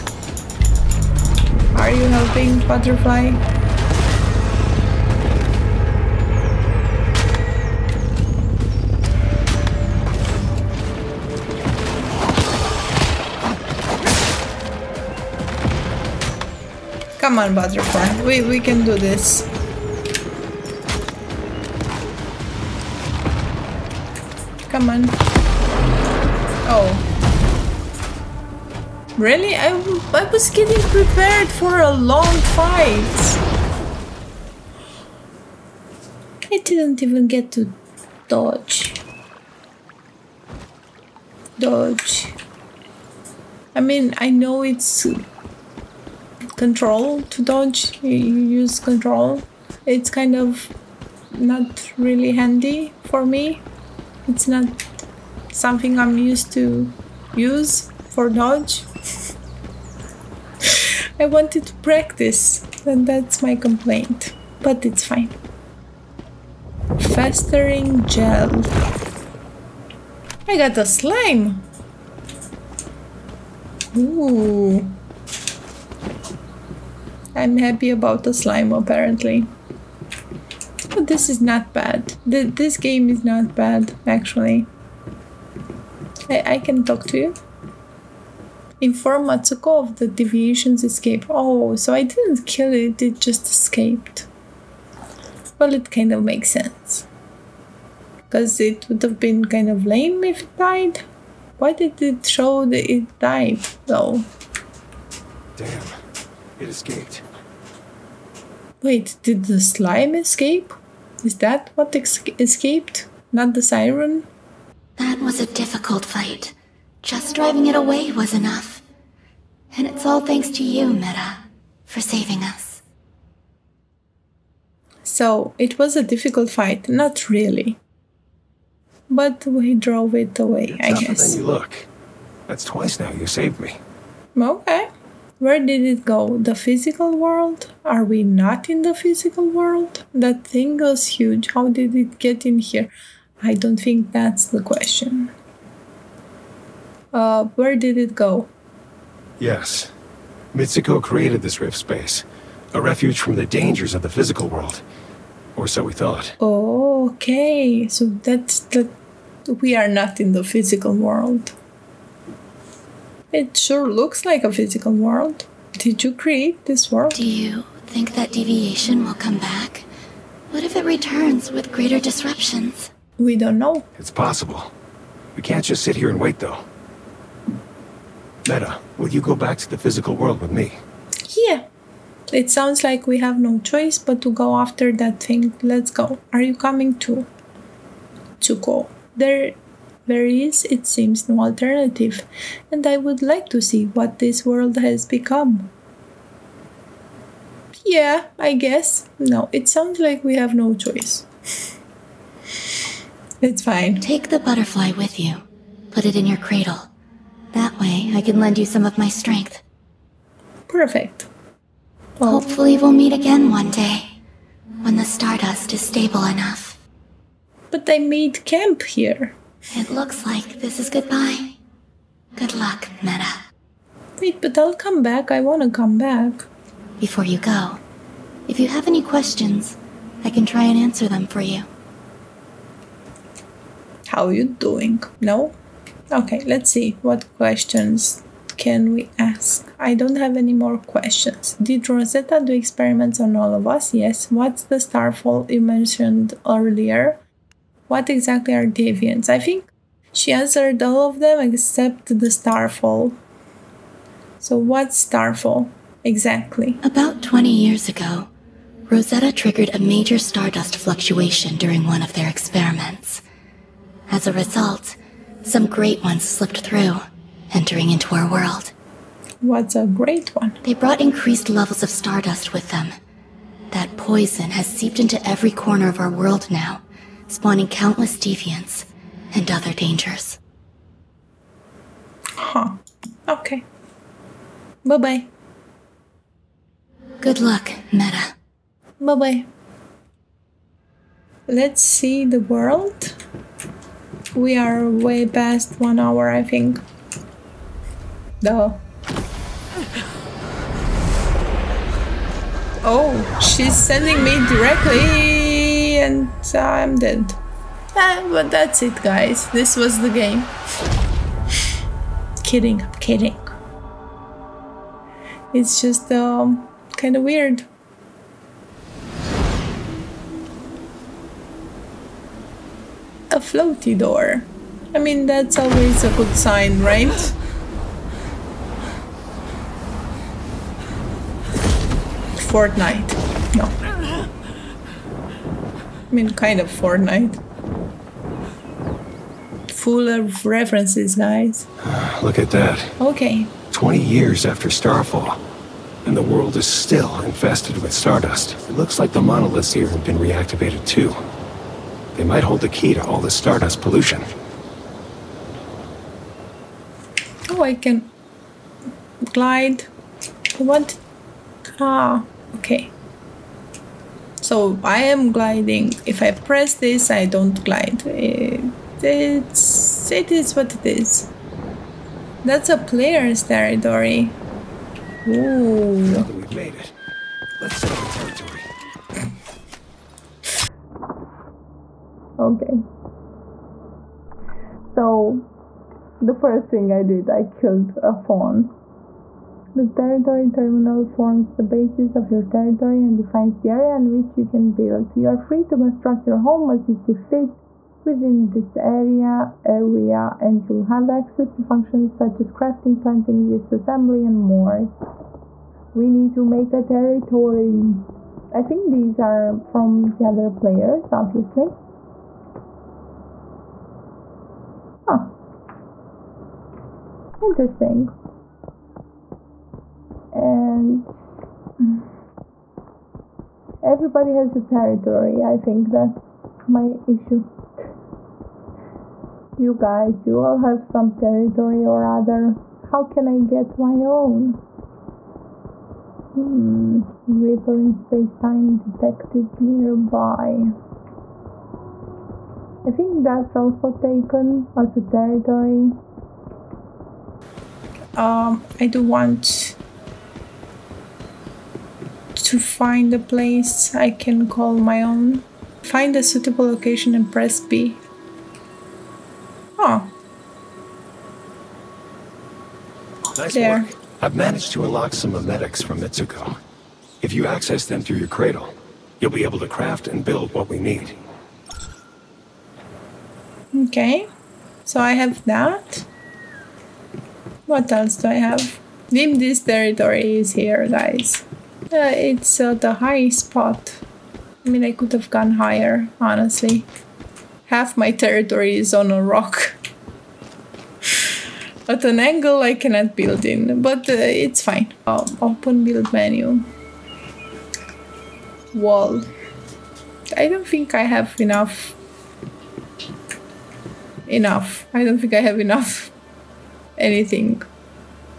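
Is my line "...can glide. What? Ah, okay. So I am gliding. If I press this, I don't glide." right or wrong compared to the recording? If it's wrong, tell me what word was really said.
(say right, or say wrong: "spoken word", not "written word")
right.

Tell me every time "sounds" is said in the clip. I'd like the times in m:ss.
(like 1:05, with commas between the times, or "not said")
3:02, 3:19.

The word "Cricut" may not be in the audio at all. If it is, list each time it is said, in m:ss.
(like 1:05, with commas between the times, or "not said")
not said.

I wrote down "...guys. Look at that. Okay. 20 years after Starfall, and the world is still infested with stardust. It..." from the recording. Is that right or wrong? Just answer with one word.
right.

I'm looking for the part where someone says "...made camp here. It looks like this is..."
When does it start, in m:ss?
3:38.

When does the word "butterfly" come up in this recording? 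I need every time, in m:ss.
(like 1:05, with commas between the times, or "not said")
0:02, 0:17, 3:24.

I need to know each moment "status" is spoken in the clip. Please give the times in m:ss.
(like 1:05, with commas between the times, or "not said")
not said.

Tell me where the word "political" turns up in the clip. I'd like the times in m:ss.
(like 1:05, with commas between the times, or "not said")
not said.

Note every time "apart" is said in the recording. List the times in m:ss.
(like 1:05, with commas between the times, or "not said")
not said.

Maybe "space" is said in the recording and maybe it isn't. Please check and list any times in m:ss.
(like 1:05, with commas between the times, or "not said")
2:31, 7:17.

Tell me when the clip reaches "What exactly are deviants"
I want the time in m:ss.
4:07.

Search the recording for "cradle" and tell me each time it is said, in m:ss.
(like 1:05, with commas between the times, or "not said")
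3:26, 7:48.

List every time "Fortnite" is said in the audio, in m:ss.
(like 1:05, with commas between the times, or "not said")
5:32, 5:36.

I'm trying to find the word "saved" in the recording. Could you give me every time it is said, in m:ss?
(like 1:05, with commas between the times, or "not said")
2:13.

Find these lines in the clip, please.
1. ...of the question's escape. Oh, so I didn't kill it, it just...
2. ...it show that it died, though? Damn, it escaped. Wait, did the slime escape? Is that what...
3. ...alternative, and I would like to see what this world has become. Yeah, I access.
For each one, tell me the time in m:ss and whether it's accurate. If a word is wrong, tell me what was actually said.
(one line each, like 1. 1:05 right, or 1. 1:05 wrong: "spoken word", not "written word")
1. 1:29 wrong: "deviation", not "question"
2. 1:42 right
3. 3:11 wrong: "guess", not "access".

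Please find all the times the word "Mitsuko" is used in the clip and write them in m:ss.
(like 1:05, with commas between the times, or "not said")
1:29, 2:30, 7:46.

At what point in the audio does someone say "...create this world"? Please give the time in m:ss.
2:46.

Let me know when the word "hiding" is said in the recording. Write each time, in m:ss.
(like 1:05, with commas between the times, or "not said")
not said.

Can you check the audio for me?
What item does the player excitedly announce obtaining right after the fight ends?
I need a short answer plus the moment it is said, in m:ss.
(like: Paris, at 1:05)
Festering gel, at 1:07.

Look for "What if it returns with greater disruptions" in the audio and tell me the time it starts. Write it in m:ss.
2:50.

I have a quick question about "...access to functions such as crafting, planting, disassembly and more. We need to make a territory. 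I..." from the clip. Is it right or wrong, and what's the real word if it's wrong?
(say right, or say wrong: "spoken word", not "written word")
right.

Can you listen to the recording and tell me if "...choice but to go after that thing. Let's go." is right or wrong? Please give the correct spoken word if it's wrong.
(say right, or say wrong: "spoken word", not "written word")
right.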